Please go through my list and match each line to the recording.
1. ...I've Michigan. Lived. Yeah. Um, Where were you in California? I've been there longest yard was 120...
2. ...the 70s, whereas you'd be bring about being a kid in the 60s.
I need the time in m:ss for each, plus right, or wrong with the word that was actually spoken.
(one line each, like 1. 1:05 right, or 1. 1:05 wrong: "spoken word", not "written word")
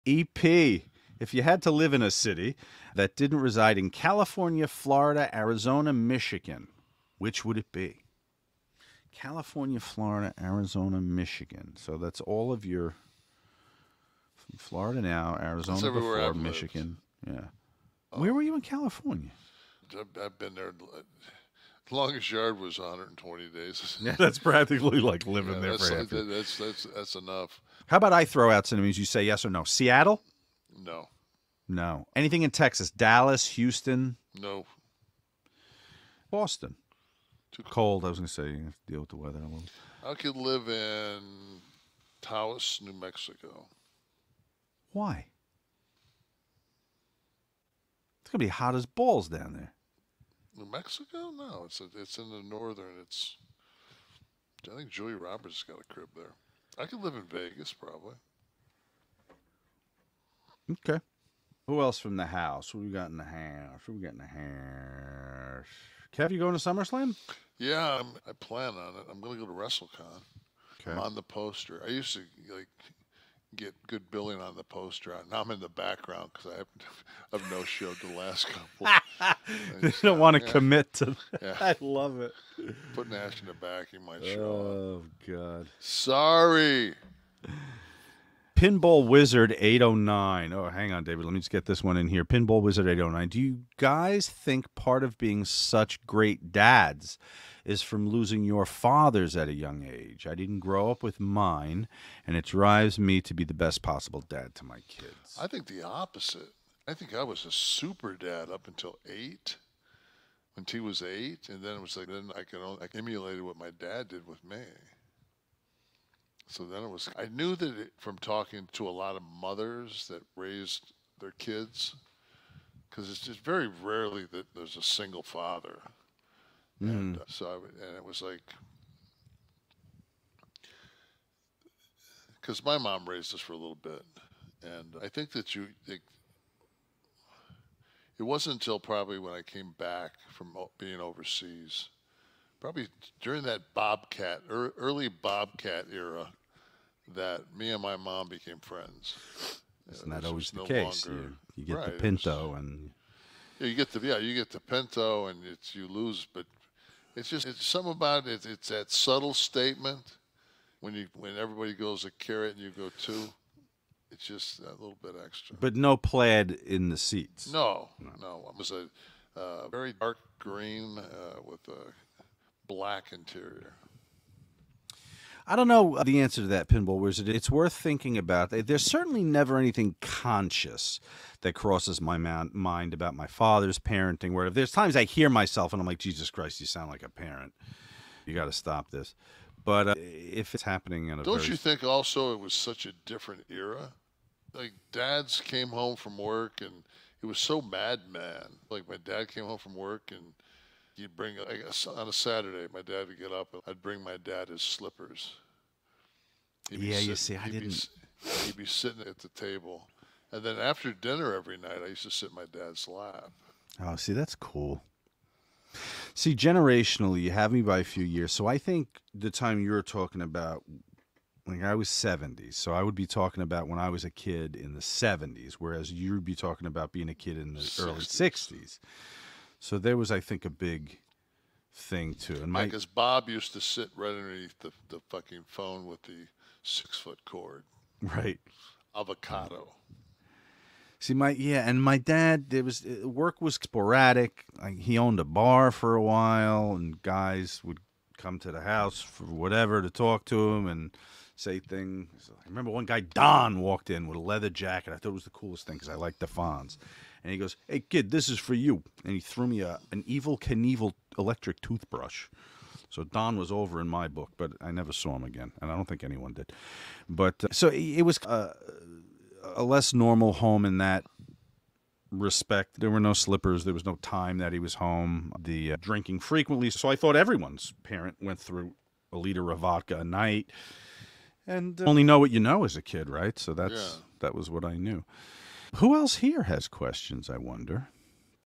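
1. 0:16 right
2. 3:44 wrong: "talking", not "bring".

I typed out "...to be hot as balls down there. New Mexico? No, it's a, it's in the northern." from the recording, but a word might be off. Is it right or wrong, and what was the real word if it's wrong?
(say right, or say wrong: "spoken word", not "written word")
right.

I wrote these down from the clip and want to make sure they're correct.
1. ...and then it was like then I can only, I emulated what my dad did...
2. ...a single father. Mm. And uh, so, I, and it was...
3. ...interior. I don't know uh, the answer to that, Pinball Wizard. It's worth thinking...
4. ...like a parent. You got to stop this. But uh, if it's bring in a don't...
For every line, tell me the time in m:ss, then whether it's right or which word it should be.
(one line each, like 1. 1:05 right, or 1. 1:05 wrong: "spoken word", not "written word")
1. 1:51 right
2. 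2:04 right
3. 2:53 right
4. 3:06 wrong: "happening", not "bring".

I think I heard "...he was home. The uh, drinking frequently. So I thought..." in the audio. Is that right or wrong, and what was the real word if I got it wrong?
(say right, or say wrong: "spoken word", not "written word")
right.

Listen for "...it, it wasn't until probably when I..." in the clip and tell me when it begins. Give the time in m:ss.
2:15.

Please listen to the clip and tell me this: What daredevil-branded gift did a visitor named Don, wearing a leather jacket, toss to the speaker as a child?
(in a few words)
Evel Knievel electric toothbrush.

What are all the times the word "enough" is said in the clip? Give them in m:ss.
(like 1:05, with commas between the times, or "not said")
0:27.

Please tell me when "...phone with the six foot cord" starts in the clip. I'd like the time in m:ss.
3:55.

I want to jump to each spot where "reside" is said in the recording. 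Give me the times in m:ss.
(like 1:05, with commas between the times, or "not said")
0:03.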